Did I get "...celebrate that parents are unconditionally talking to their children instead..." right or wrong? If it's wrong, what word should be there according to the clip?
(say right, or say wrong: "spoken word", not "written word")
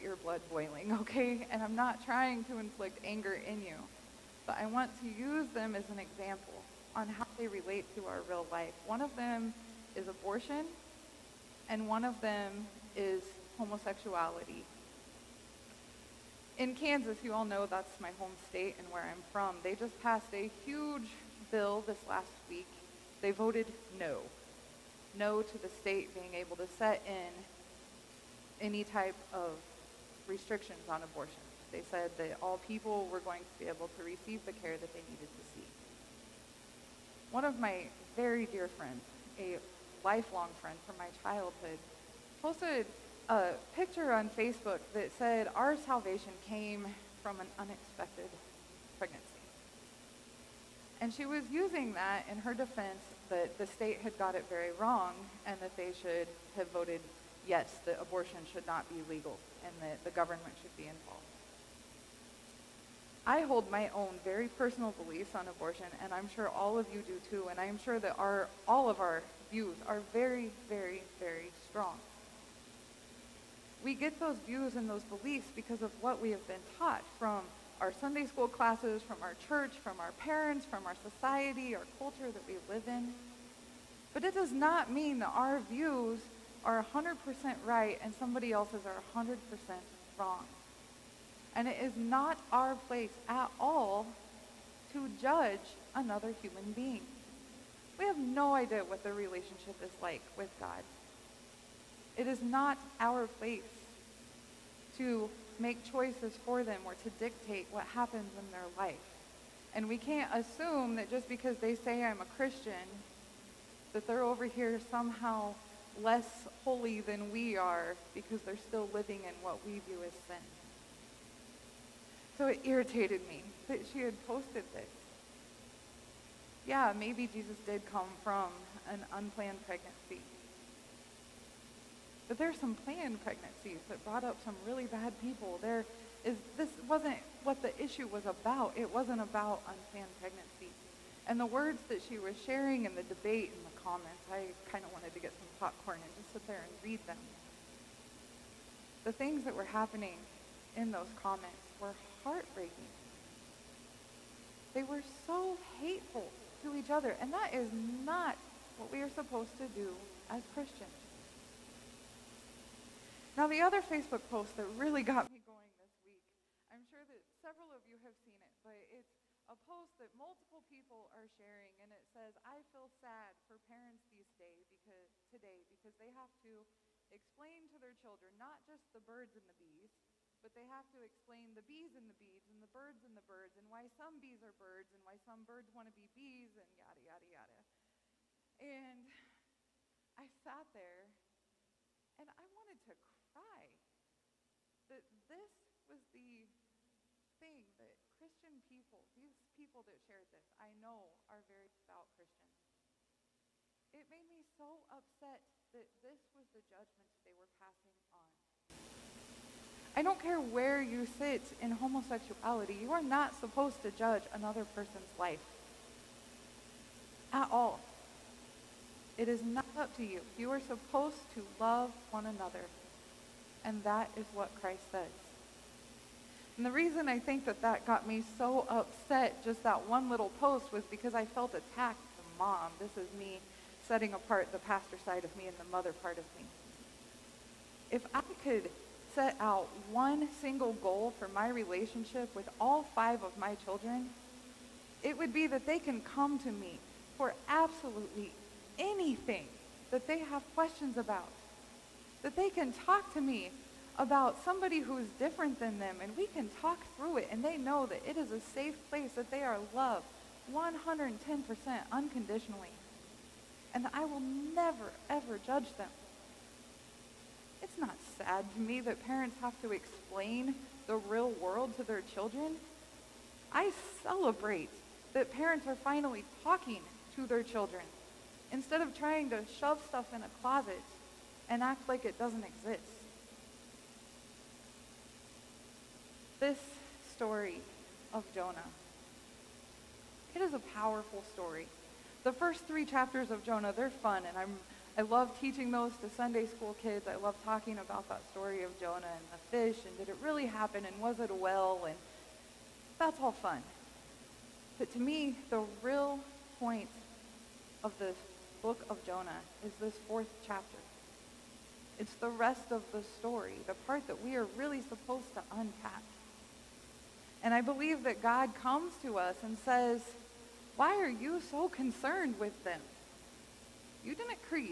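wrong: "finally", not "unconditionally".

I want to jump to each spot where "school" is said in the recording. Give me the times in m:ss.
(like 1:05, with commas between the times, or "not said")
1:18, 4:56.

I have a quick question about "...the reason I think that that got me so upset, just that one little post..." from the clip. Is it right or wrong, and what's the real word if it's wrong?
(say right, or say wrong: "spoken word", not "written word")
right.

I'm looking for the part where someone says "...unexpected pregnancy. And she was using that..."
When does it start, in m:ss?
0:47.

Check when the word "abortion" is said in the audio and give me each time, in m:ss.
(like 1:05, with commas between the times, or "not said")
0:10, 0:31, 0:58, 1:05.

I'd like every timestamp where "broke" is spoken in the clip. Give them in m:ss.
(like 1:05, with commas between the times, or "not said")
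not said.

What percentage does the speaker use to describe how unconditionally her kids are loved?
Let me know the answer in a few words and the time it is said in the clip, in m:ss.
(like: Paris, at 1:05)
110%, at 4:20.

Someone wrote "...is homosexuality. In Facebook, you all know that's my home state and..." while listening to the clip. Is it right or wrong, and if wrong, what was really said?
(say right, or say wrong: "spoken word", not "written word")
wrong: "Kansas", not "Facebook".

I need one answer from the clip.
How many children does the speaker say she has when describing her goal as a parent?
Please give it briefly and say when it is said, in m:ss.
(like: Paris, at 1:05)
5, at 4:02.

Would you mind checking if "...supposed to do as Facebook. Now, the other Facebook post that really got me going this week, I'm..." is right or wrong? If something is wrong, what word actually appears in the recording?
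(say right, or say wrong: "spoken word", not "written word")
wrong: "Christians", not "Facebook".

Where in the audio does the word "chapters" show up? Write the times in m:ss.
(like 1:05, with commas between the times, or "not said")
4:52, 5:10.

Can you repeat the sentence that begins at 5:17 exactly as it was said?
And I believe that God comes to us and says, why are you so concerned with them?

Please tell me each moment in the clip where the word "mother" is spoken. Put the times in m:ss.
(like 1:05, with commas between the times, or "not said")
3:55.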